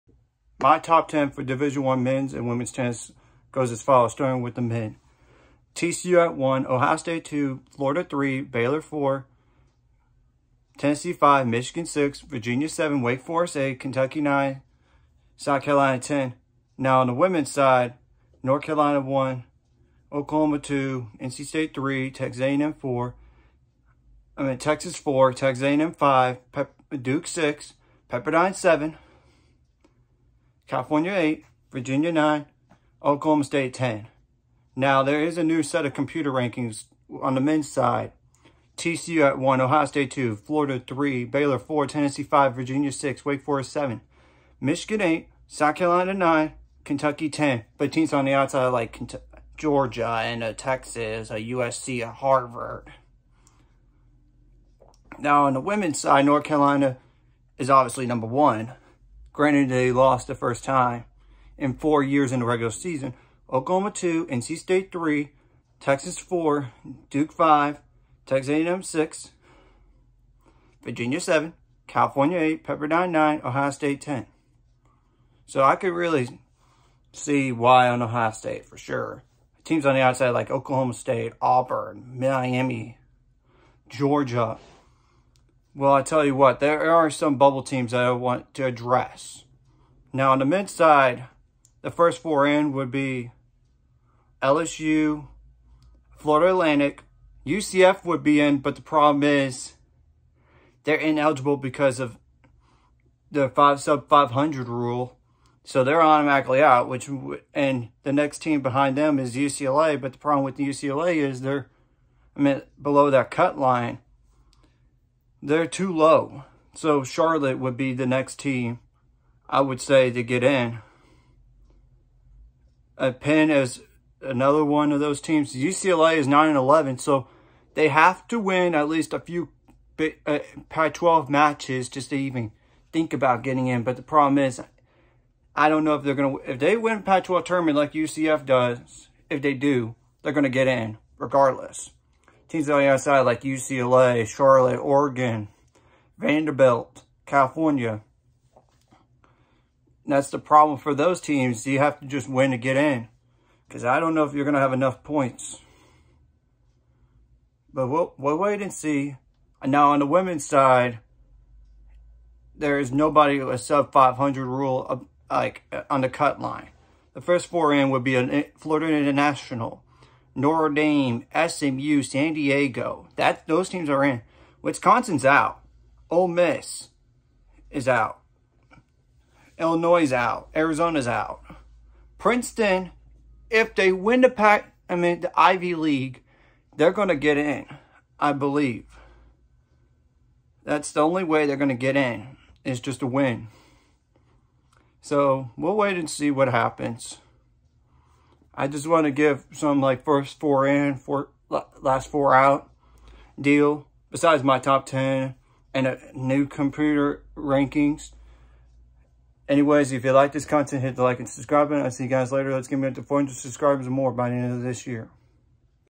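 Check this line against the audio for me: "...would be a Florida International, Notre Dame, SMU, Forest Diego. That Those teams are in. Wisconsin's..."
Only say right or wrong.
wrong.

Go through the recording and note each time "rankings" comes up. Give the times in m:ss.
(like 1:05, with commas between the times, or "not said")
0:36, 3:27.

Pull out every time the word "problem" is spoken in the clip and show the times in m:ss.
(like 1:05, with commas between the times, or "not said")
1:38, 1:50, 2:14, 2:30.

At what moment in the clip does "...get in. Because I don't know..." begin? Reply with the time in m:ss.
2:32.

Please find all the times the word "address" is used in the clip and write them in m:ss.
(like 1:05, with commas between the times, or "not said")
1:28.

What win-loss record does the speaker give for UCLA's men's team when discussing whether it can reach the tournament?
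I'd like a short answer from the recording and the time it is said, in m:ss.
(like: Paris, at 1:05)
9-11, at 2:06.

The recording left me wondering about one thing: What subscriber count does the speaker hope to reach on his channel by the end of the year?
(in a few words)
400.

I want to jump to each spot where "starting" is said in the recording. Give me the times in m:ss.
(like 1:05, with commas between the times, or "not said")
0:04.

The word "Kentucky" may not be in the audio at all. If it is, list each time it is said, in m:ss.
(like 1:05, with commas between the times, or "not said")
0:13, 0:46.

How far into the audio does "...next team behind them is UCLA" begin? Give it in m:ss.
1:48.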